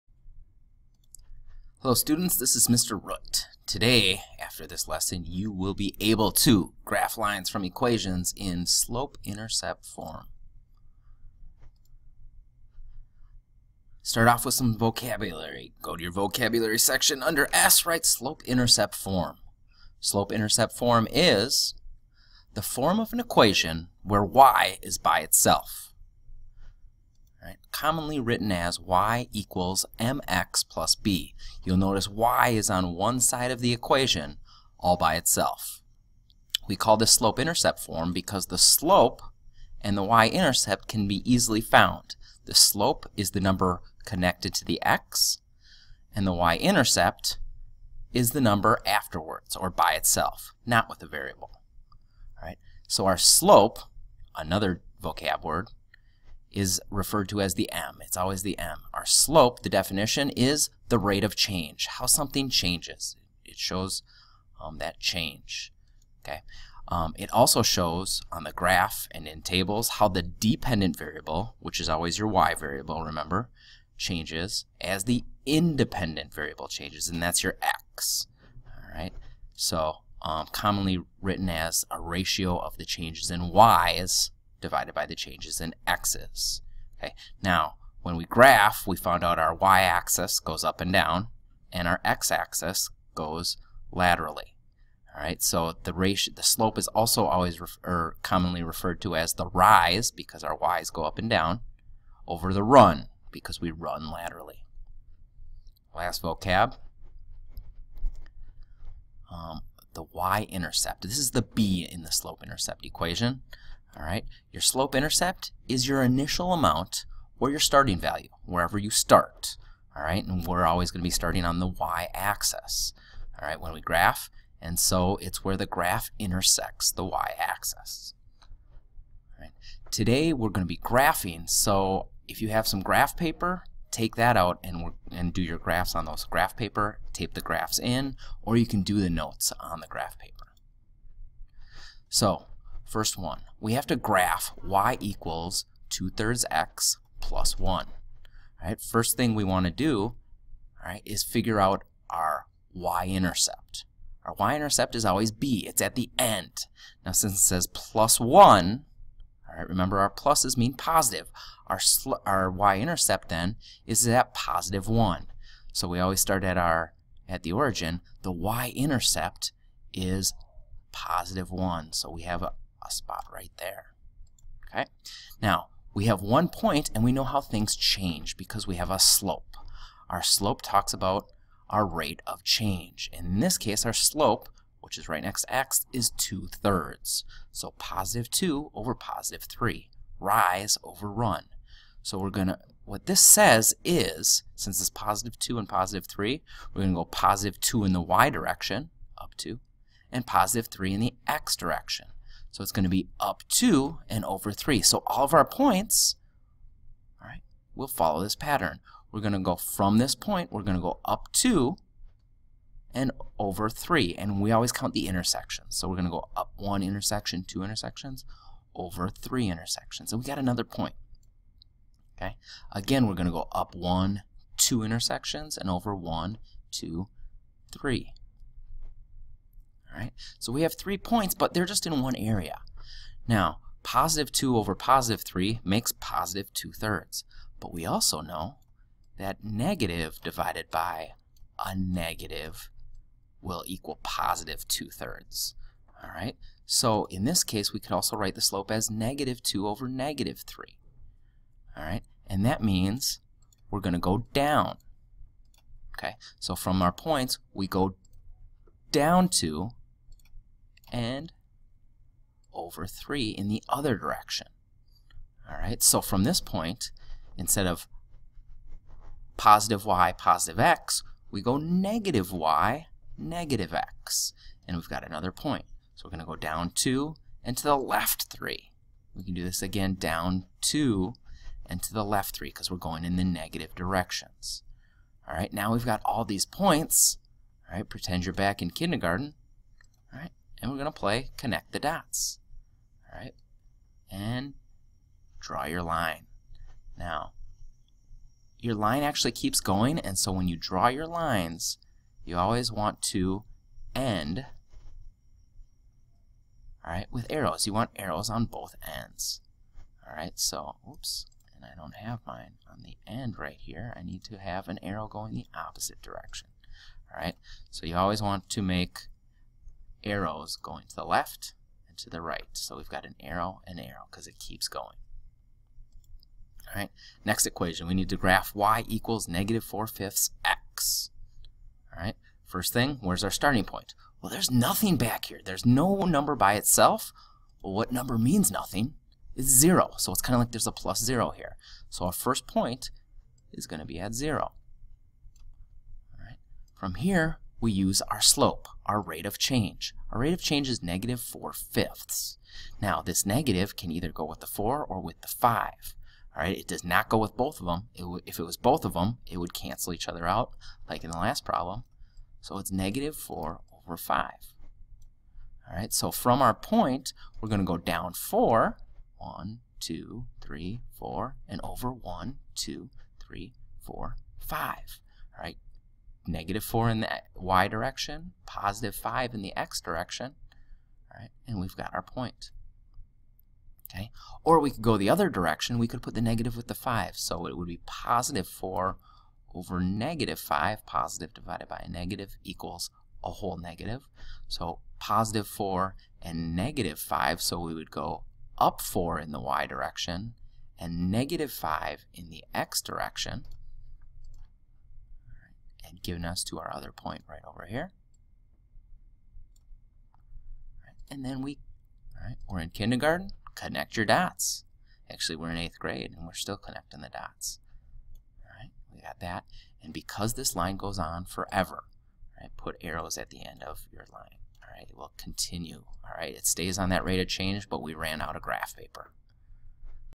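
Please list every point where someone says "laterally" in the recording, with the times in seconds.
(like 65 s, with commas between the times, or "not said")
93 s, 104 s.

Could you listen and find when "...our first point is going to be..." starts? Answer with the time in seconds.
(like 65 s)
342 s.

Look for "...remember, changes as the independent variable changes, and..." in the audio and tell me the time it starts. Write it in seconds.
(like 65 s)
73 s.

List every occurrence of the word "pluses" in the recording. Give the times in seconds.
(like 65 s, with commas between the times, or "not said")
160 s.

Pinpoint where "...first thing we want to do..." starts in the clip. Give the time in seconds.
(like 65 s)
148 s.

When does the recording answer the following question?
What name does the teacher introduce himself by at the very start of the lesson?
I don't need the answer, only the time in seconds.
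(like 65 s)
2 s.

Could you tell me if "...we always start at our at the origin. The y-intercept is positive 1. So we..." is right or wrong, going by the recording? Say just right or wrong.
right.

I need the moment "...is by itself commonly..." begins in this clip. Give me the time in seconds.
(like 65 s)
24 s.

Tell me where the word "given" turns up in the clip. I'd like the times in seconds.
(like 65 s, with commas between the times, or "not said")
406 s.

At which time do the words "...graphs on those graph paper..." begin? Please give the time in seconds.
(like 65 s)
135 s.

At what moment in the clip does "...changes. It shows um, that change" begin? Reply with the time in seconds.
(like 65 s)
62 s.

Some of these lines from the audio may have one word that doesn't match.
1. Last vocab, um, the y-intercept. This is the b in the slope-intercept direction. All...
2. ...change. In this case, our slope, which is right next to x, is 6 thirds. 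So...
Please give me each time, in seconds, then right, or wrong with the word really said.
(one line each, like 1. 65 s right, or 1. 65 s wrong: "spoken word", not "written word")
1. 105 s wrong: "equation", not "direction"
2. 182 s wrong: "2", not "6".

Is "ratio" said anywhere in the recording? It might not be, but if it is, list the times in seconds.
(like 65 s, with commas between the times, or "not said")
81 s, 95 s.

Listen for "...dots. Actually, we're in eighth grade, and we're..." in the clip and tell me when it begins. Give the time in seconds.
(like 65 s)
414 s.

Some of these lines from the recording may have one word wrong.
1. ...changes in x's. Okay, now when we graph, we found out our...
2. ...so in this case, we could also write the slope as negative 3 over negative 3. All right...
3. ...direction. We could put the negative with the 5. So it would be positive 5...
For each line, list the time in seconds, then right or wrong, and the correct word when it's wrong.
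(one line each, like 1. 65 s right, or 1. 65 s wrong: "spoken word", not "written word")
1. 85 s right
2. 246 s wrong: "2", not "3"
3. 385 s wrong: "4", not "5".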